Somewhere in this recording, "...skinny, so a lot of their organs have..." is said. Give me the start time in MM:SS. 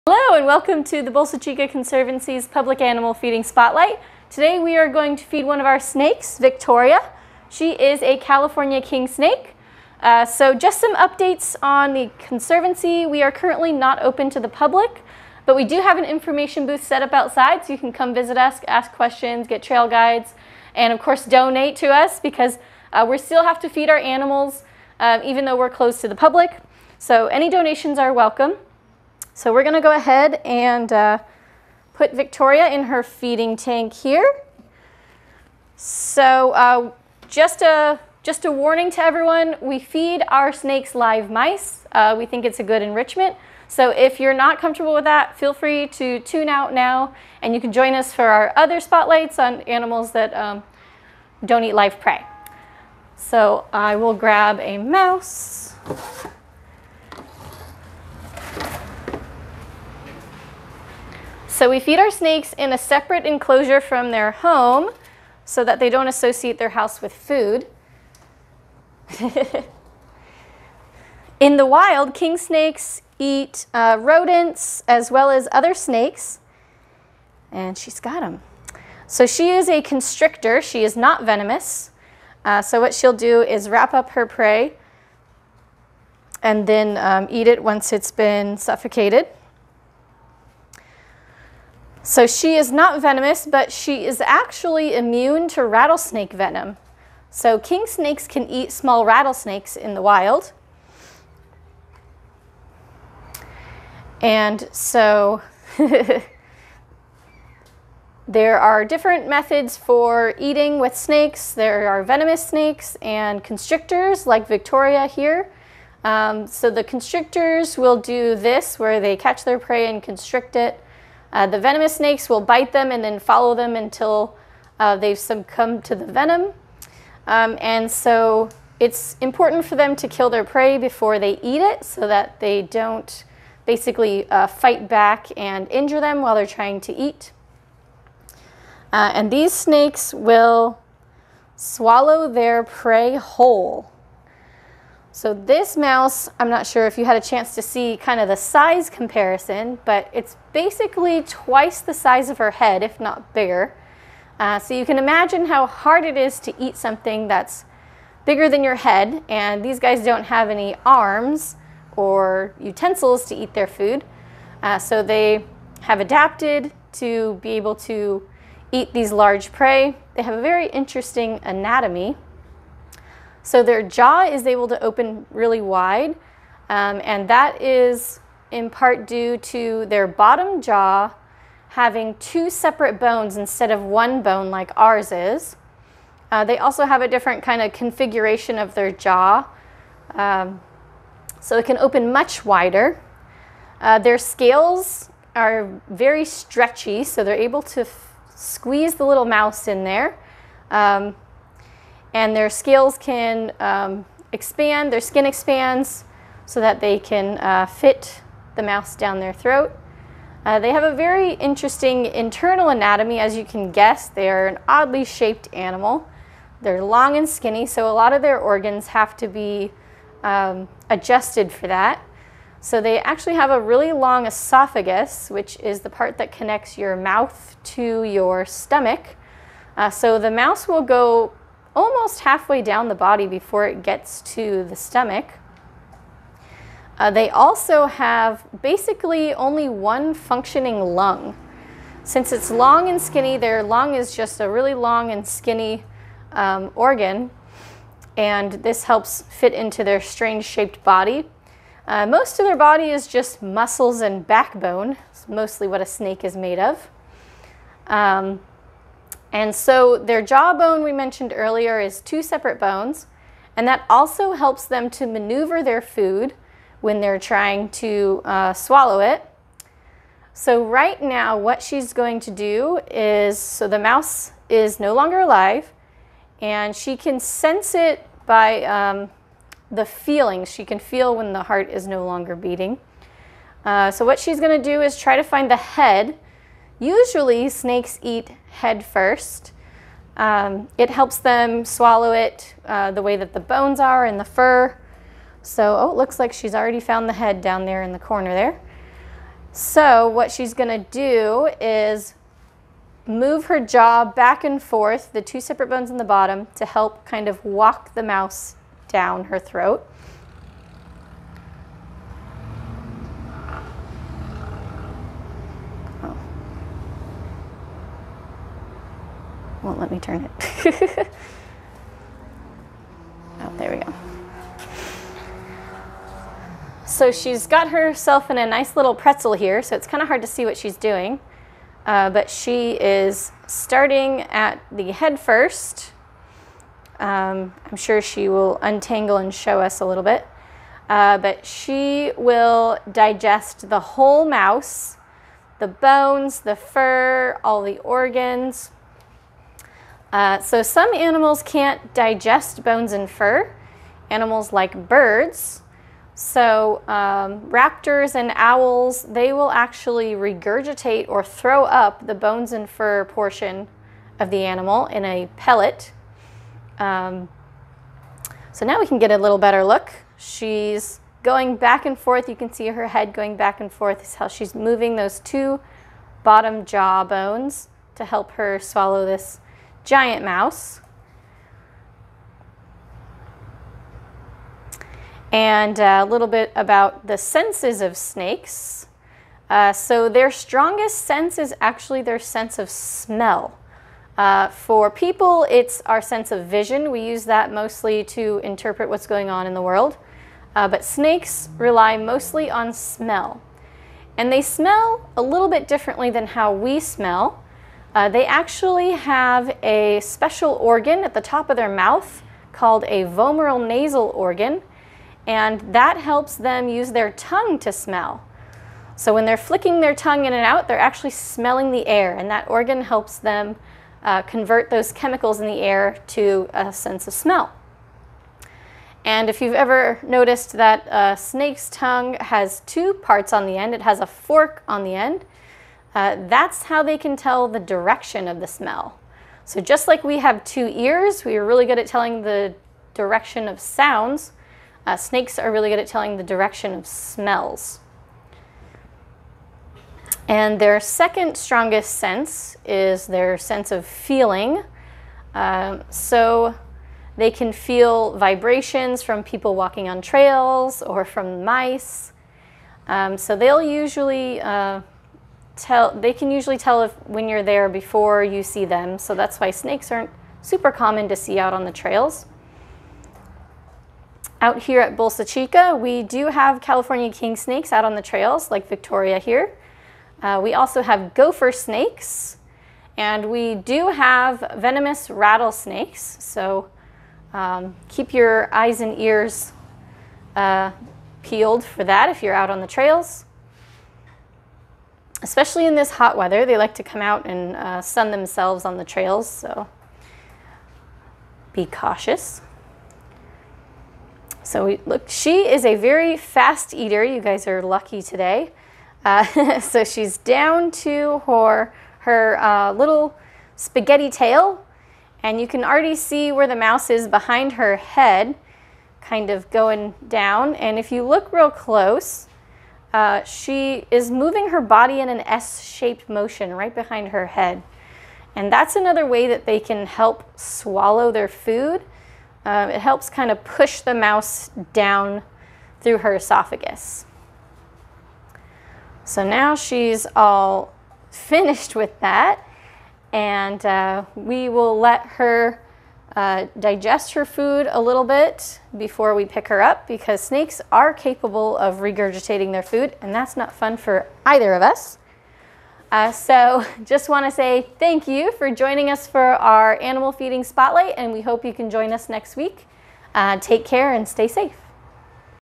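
03:37.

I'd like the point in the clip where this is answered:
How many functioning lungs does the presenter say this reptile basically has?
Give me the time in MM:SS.
03:59.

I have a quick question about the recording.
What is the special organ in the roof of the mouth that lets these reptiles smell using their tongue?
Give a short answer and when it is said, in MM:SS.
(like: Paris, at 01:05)
Vomeronasal organ, at 06:53.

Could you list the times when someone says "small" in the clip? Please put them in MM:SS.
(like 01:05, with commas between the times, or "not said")
01:38.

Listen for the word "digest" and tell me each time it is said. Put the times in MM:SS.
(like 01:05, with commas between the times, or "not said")
05:42, 05:51, 09:06.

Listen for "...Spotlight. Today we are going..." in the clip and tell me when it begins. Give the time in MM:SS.
00:03.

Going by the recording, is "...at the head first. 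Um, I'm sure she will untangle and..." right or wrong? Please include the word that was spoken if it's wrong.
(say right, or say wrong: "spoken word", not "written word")
right.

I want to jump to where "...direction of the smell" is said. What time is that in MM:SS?
07:17.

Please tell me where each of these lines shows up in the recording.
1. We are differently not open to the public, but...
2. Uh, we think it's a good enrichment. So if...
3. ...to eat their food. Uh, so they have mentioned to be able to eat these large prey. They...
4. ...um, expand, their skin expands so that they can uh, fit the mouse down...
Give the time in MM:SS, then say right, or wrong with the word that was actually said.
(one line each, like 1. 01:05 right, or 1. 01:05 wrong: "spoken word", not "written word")
1. 00:13 wrong: "currently", not "differently"
2. 00:41 right
3. 02:43 wrong: "adapted", not "mentioned"
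4. 03:23 right.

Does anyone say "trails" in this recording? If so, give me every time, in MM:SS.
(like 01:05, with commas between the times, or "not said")
00:19, 07:40, 07:51, 07:58, 08:12, 08:18.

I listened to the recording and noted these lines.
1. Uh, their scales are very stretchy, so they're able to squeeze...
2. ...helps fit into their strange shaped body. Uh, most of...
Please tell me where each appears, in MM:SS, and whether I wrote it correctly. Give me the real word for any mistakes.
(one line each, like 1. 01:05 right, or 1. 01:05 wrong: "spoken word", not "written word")
1. 03:13 right
2. 04:08 right.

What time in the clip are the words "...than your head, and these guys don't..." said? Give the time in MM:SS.
02:38.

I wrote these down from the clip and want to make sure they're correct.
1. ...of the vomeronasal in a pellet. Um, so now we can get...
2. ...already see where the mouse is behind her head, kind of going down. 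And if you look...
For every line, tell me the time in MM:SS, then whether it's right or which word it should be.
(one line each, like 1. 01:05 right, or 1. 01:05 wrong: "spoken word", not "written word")
1. 06:04 wrong: "animal", not "vomeronasal"
2. 08:35 right.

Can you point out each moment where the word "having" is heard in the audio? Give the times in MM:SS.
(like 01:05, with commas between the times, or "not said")
03:01.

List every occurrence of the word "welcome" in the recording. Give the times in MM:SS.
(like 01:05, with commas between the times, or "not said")
00:00, 00:28.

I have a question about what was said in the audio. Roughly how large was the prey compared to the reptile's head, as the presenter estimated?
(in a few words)
Twice the size.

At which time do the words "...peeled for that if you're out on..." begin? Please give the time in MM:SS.
08:11.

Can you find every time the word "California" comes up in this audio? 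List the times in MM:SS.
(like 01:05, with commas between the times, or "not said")
00:08, 07:56.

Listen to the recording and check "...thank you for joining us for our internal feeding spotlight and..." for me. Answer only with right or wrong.
wrong.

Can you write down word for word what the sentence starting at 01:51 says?
There are venomous snakes and constrictors like Victoria here.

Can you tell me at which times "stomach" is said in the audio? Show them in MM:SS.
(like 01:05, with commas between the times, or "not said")
03:48, 03:54.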